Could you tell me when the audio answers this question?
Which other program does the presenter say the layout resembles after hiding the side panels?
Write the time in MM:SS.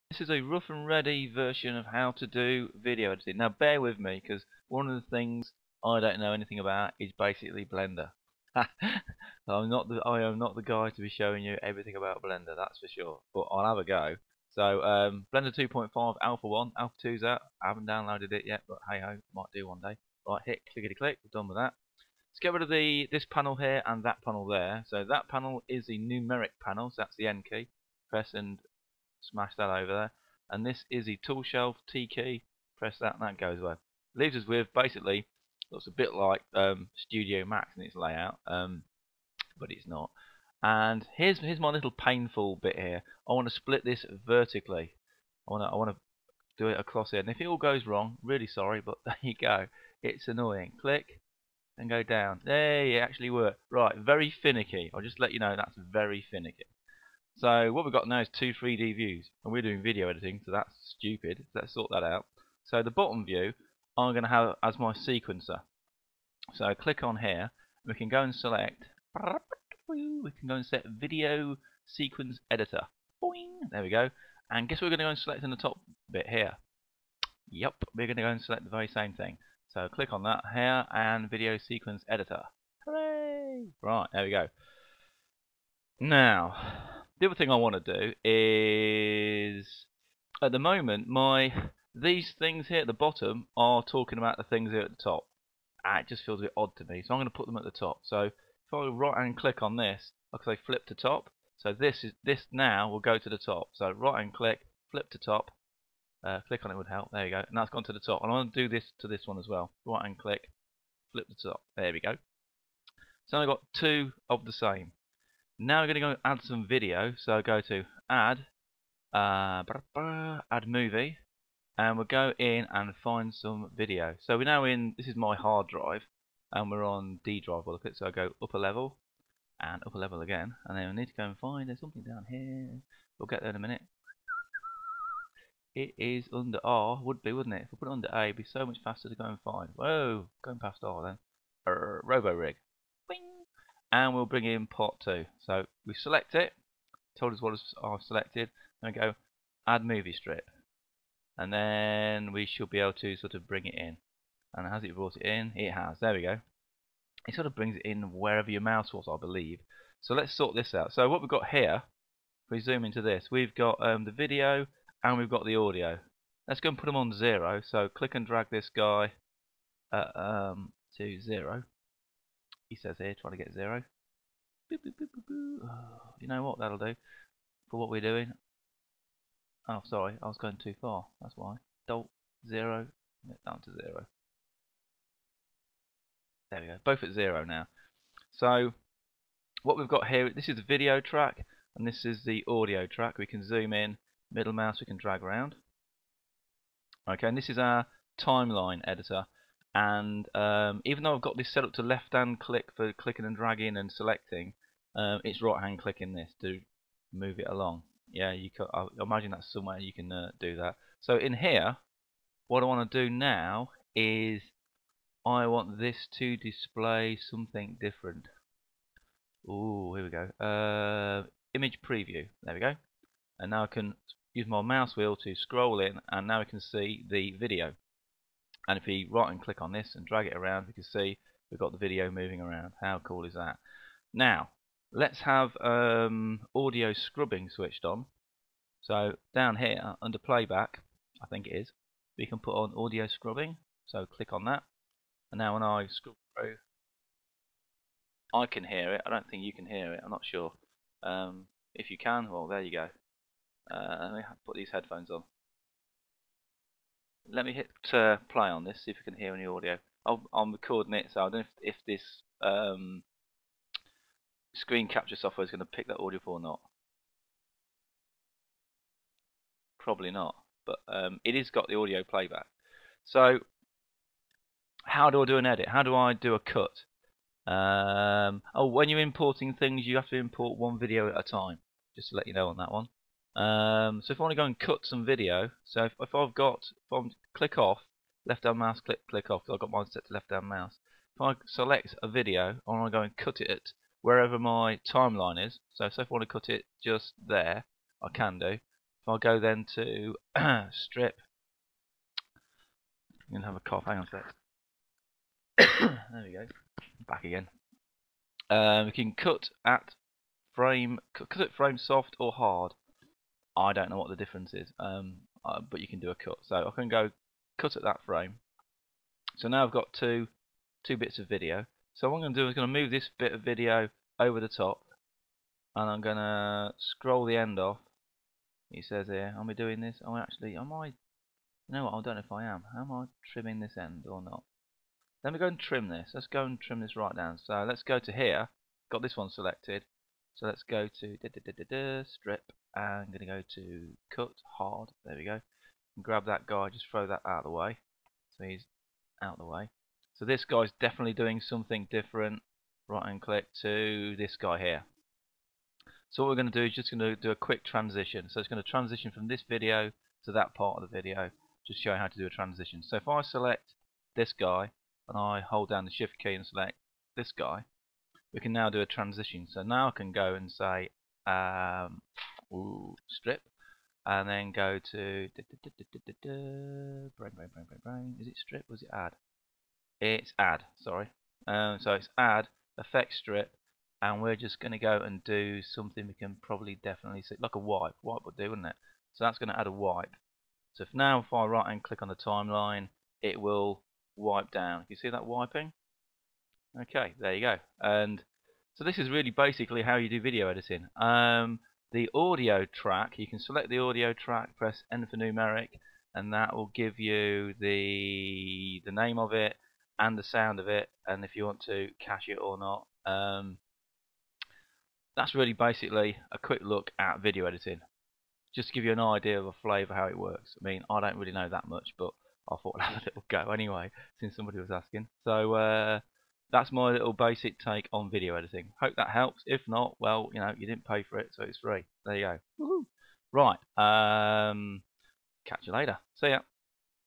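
00:36.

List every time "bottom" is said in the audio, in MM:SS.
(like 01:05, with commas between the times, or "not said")
01:02, 01:32.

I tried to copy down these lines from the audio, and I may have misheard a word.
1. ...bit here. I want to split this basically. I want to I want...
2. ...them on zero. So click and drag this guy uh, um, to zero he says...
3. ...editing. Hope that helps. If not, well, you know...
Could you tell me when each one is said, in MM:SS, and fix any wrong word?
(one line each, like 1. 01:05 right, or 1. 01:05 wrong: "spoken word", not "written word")
1. 00:42 wrong: "vertically", not "basically"
2. 02:46 right
3. 07:08 right.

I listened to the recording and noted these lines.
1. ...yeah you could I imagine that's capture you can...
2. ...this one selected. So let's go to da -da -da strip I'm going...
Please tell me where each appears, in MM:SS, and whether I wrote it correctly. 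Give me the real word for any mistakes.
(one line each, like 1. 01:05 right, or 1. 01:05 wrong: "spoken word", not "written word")
1. 03:28 wrong: "somewhere", not "capture"
2. 05:39 right.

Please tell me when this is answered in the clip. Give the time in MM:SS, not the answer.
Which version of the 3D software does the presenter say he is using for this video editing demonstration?
00:15.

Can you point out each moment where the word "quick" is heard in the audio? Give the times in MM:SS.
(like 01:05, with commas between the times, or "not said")
05:57, 06:56.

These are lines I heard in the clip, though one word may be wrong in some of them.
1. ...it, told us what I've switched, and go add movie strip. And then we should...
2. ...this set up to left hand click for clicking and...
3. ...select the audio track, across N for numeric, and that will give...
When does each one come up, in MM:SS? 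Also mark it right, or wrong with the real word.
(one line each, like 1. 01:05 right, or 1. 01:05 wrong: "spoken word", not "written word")
1. 02:26 wrong: "selected", not "switched"
2. 03:21 right
3. 06:43 wrong: "press", not "across".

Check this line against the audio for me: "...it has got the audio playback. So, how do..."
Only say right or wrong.
right.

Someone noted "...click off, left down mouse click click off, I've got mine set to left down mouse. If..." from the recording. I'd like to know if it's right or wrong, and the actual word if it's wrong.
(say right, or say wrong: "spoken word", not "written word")
right.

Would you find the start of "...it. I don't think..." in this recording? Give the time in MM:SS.
04:08.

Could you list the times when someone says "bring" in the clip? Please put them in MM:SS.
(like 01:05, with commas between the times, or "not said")
02:24, 02:33, 02:37.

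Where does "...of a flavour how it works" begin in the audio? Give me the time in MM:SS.
06:59.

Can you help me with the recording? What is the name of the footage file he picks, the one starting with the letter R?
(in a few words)
Robo rig.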